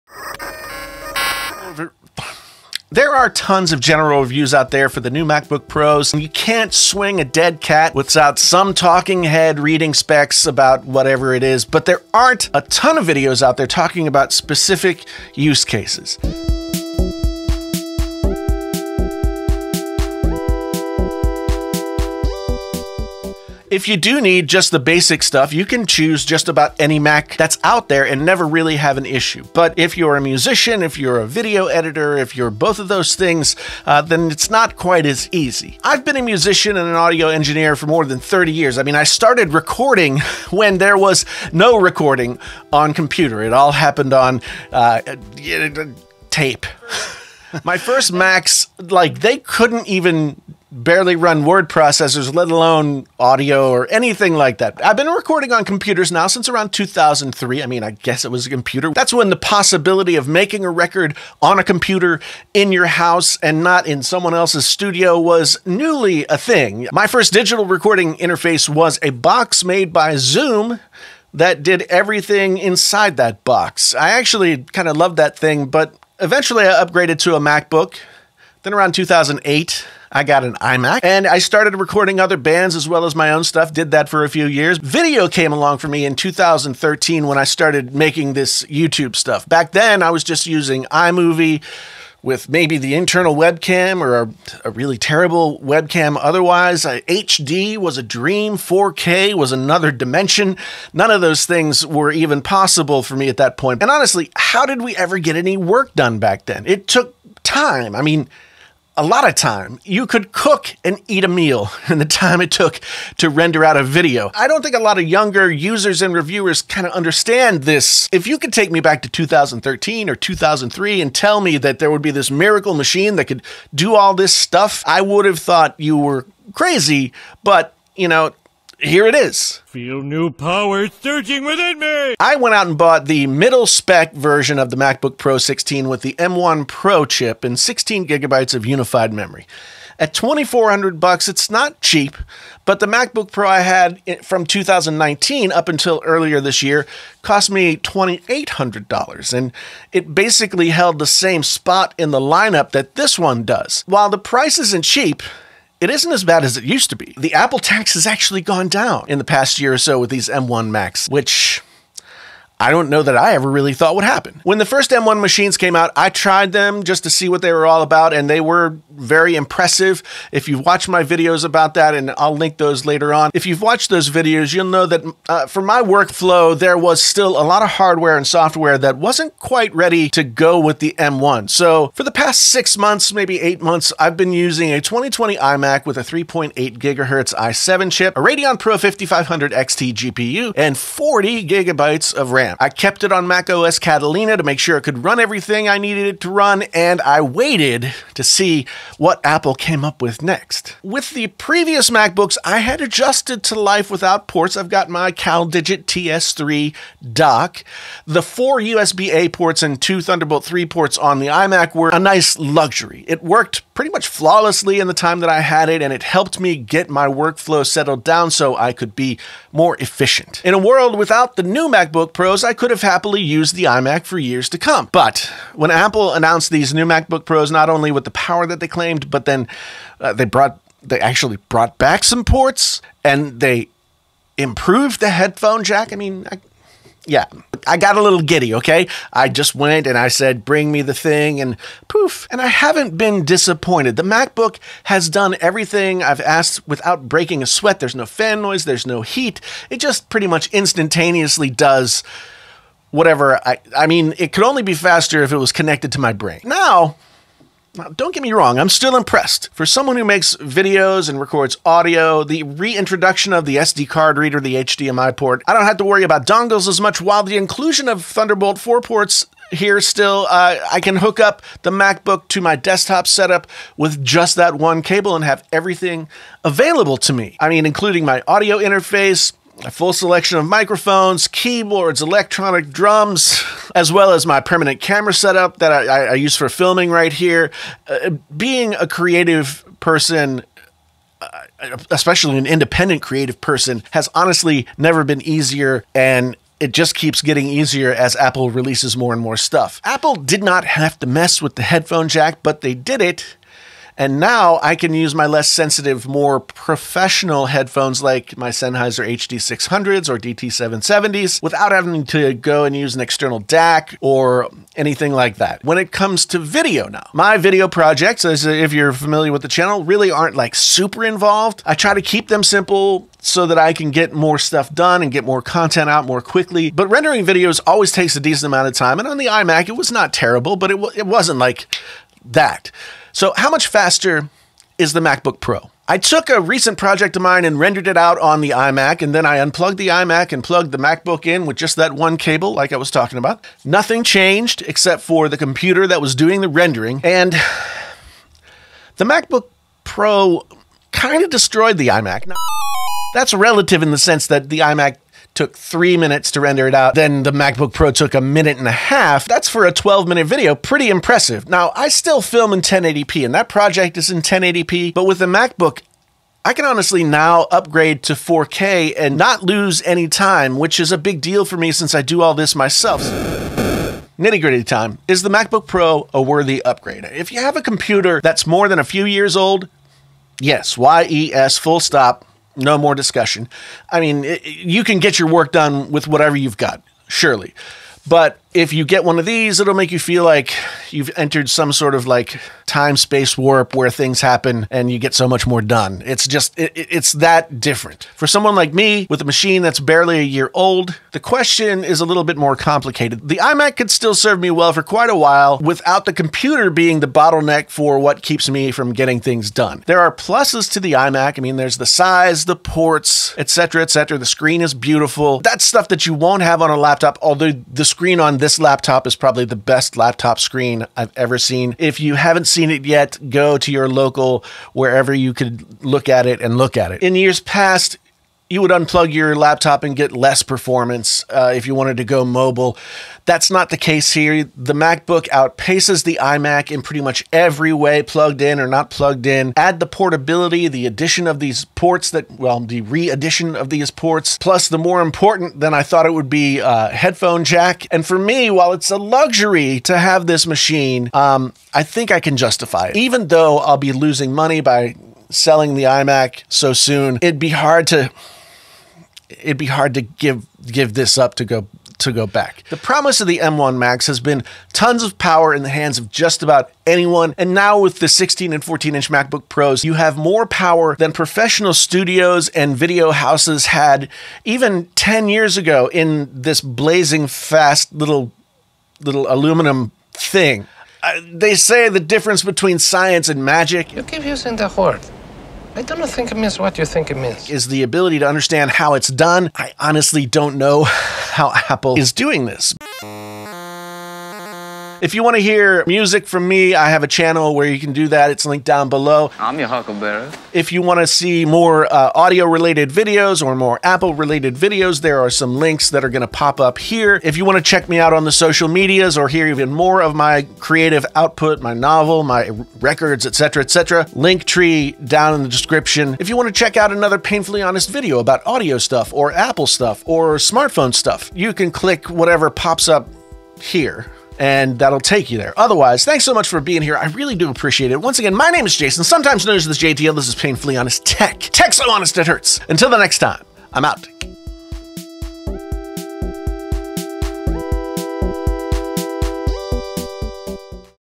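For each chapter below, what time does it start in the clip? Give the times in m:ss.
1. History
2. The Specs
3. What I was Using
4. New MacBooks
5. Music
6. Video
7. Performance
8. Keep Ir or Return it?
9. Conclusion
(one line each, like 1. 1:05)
1. 0:35
2. 2:10
3. 3:00
4. 3:45
5. 4:03
6. 5:15
7. 5:35
8. 6:13
9. 7:45.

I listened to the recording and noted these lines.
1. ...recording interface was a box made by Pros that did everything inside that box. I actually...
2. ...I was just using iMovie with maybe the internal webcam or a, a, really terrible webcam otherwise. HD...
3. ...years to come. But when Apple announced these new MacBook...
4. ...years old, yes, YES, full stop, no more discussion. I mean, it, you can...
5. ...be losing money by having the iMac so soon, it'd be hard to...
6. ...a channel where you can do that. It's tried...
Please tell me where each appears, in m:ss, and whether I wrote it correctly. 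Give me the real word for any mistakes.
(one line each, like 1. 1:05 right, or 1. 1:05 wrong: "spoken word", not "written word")
1. 1:07 wrong: "Zoom", not "Pros"
2. 1:30 right
3. 3:44 right
4. 6:19 right
5. 7:33 wrong: "selling", not "having"
6. 8:17 wrong: "linked", not "tried".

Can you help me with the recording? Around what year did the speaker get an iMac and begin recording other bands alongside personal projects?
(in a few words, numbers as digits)
2008.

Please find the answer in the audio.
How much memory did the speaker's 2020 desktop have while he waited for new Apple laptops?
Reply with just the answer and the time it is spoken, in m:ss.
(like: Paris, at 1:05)
40 gigabytes, at 3:10.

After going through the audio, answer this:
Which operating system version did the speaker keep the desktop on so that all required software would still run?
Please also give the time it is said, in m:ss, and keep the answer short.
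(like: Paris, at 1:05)
Catalina, at 3:13.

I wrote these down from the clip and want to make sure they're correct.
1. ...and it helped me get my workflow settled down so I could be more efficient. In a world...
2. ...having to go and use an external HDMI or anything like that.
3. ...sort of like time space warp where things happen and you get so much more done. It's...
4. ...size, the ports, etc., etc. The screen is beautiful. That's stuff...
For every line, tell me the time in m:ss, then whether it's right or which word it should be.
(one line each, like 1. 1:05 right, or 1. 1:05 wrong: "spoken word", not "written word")
1. 3:35 right
2. 5:11 wrong: "DAC", not "HDMI"
3. 6:31 right
4. 6:51 right.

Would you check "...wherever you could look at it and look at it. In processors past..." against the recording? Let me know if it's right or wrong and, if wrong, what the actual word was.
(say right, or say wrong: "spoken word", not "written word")
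wrong: "years", not "processors".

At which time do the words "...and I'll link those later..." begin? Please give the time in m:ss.
2:51.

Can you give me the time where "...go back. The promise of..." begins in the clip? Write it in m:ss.
7:42.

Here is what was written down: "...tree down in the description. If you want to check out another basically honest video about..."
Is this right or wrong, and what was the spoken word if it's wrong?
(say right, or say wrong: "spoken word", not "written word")
wrong: "painfully", not "basically".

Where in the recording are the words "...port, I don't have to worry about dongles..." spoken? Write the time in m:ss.
4:25.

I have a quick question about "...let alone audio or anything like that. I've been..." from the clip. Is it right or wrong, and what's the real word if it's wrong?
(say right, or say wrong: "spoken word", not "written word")
right.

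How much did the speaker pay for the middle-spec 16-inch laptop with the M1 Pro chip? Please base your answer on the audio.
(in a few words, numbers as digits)
$2400.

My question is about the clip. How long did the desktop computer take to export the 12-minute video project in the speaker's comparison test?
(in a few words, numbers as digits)
3 minutes.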